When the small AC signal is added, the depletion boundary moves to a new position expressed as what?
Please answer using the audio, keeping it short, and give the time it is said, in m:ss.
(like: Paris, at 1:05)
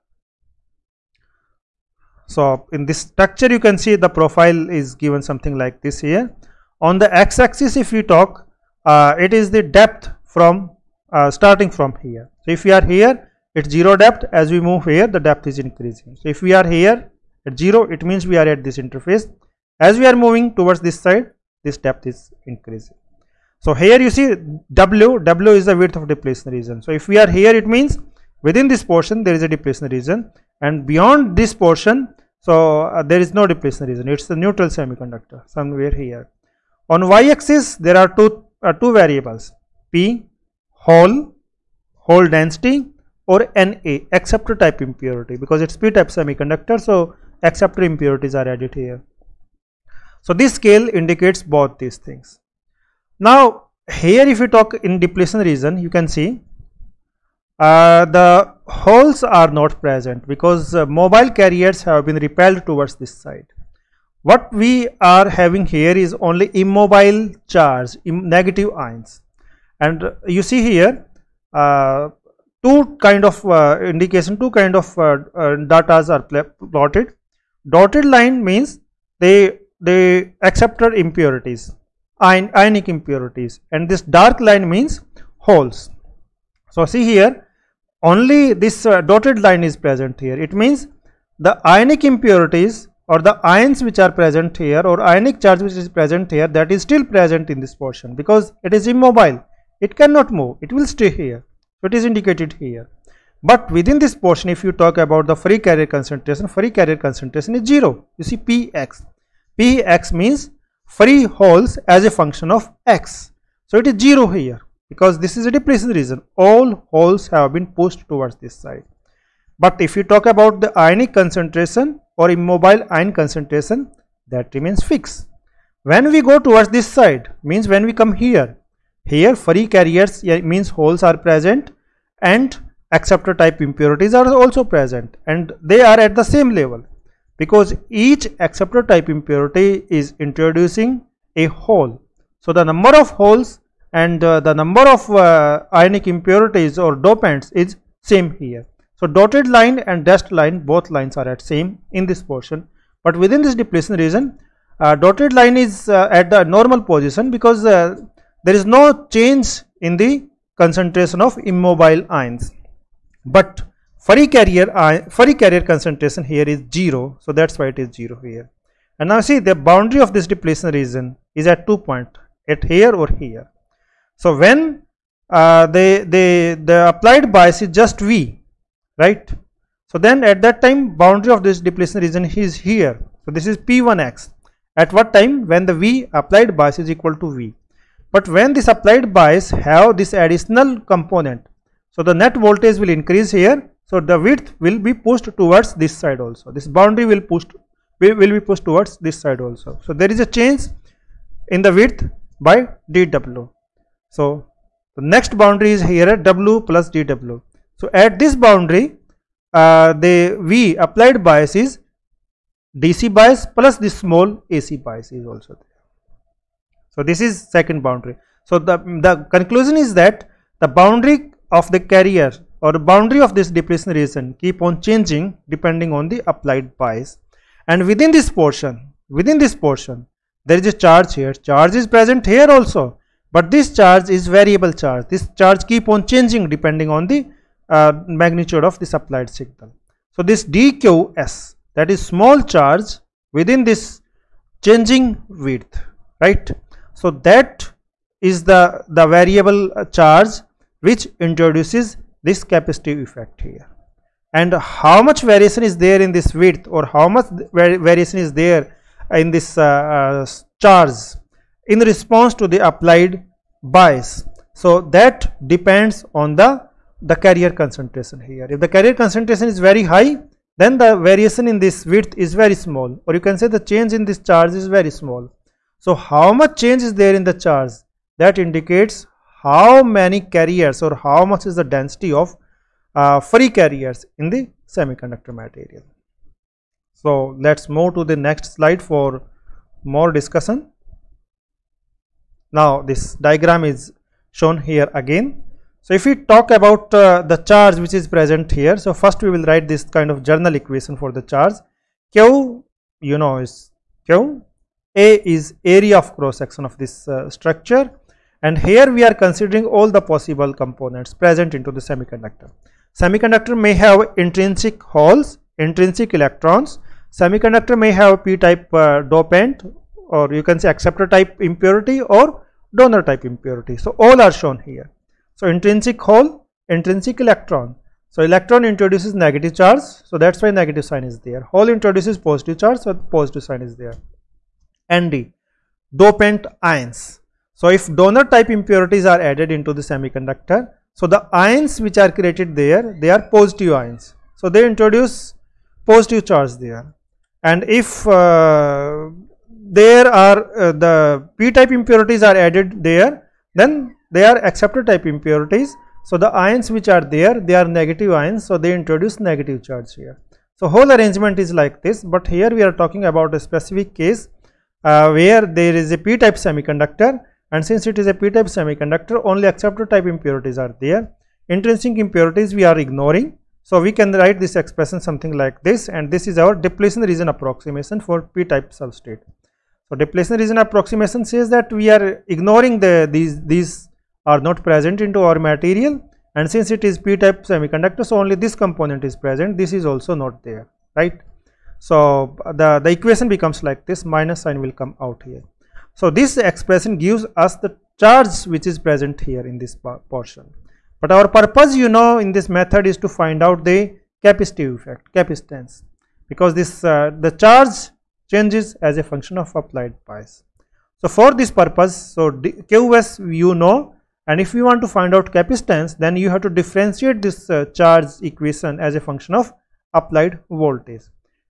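W plus dW, at 3:26.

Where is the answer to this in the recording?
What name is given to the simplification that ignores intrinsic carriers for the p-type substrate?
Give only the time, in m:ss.
6:16.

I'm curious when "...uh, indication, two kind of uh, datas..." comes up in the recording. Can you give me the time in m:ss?
1:13.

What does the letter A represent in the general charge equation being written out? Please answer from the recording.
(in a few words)
Area of cross section.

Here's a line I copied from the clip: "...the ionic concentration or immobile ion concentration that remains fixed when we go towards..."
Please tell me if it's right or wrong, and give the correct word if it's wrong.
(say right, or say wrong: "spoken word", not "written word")
right.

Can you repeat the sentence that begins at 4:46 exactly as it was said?
So let's move to the next slide for more discussion.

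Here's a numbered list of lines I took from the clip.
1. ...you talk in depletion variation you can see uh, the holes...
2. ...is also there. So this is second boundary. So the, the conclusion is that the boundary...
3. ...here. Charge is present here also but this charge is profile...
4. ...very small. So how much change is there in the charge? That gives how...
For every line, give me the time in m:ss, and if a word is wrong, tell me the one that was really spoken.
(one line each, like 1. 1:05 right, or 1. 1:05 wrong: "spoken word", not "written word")
1. 0:54 wrong: "region", not "variation"
2. 3:35 right
3. 3:51 wrong: "variable", not "profile"
4. 4:34 wrong: "indicates", not "gives".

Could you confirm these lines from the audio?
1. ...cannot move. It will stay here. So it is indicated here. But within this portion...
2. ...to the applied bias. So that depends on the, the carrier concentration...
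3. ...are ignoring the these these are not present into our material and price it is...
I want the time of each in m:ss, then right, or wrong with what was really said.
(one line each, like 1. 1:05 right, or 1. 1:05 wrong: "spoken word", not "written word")
1. 1:39 right
2. 4:22 right
3. 6:21 wrong: "since", not "price".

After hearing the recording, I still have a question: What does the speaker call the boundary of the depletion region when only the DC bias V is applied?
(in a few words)
P1x.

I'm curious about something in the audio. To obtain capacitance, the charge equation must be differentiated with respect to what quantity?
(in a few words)
Applied voltage.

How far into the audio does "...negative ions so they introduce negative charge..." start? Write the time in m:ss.
5:57.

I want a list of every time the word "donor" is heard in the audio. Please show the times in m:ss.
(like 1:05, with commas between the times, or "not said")
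5:22, 5:37.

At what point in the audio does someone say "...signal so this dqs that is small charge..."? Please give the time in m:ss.
3:59.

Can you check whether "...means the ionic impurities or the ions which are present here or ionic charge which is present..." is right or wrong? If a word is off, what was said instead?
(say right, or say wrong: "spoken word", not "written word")
right.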